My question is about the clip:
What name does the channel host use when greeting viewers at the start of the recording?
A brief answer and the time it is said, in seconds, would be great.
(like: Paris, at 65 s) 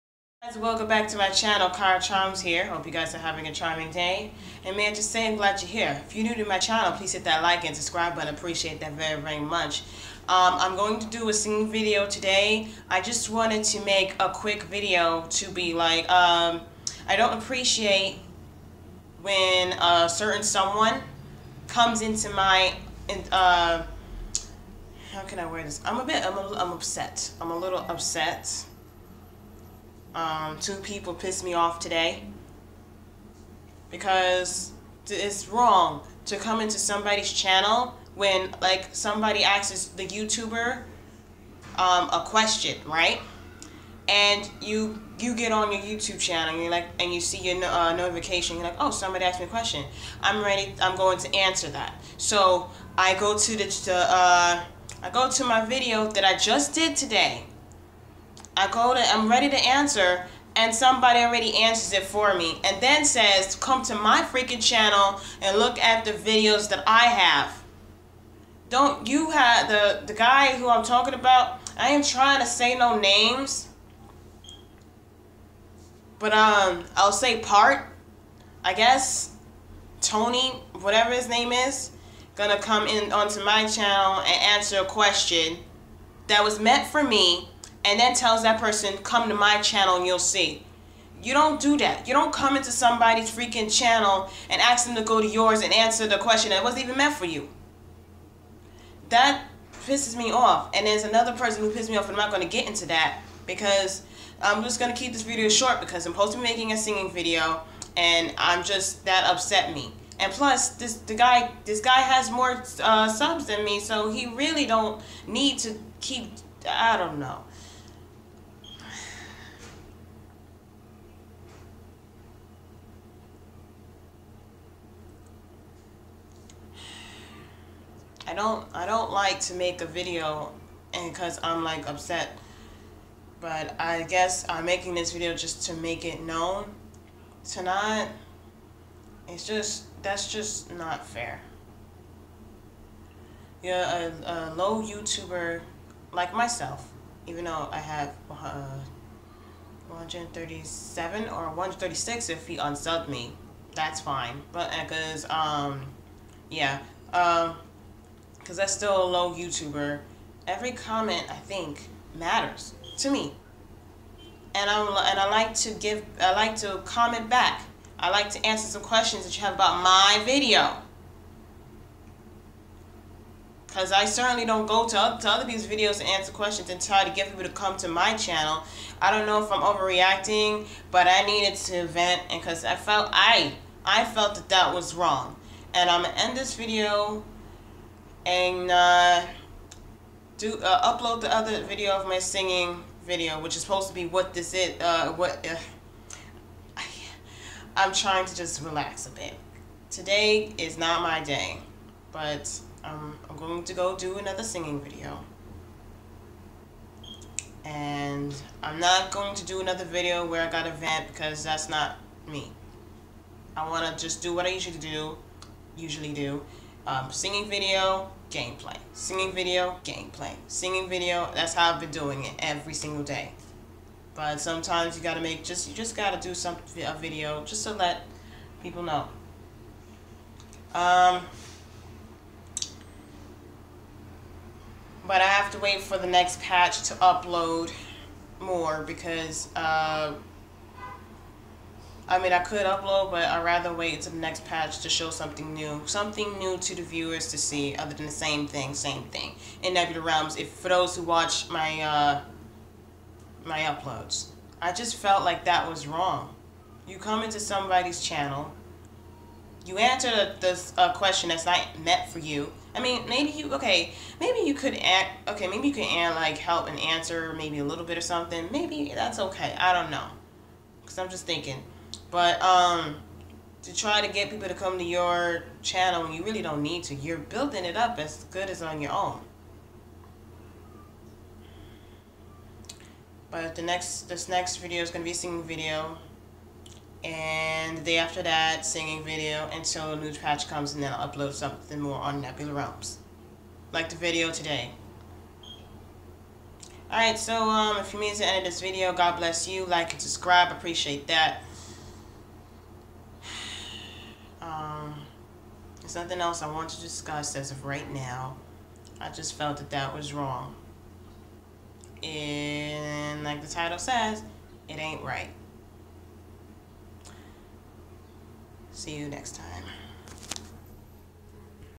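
Kira Charms, at 1 s.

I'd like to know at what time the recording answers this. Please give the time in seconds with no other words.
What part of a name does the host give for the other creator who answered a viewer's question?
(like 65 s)
80 s.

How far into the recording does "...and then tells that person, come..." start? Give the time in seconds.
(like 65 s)
87 s.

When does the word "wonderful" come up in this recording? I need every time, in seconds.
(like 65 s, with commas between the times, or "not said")
not said.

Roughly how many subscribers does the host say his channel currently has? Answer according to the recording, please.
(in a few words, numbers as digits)
137.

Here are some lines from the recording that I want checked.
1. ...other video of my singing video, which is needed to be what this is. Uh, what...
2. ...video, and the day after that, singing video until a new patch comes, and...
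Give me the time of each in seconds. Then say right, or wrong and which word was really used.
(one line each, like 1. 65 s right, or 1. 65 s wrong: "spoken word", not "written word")
1. 191 s wrong: "supposed", not "needed"
2. 285 s right.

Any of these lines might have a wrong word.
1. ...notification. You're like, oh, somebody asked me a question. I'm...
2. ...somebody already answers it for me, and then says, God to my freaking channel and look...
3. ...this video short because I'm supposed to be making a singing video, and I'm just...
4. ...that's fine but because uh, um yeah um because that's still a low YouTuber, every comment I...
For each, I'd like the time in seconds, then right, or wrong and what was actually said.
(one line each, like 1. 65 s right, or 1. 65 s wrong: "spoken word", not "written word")
1. 47 s right
2. 60 s wrong: "Come", not "God"
3. 105 s right
4. 153 s right.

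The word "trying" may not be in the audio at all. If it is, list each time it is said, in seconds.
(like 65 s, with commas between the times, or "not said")
72 s, 197 s.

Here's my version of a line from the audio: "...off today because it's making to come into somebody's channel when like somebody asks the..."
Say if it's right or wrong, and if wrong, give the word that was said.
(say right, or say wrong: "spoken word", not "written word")
wrong: "wrong", not "making".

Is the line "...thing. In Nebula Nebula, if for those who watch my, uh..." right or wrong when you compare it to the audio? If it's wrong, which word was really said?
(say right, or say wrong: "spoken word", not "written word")
wrong: "Realms", not "Nebula".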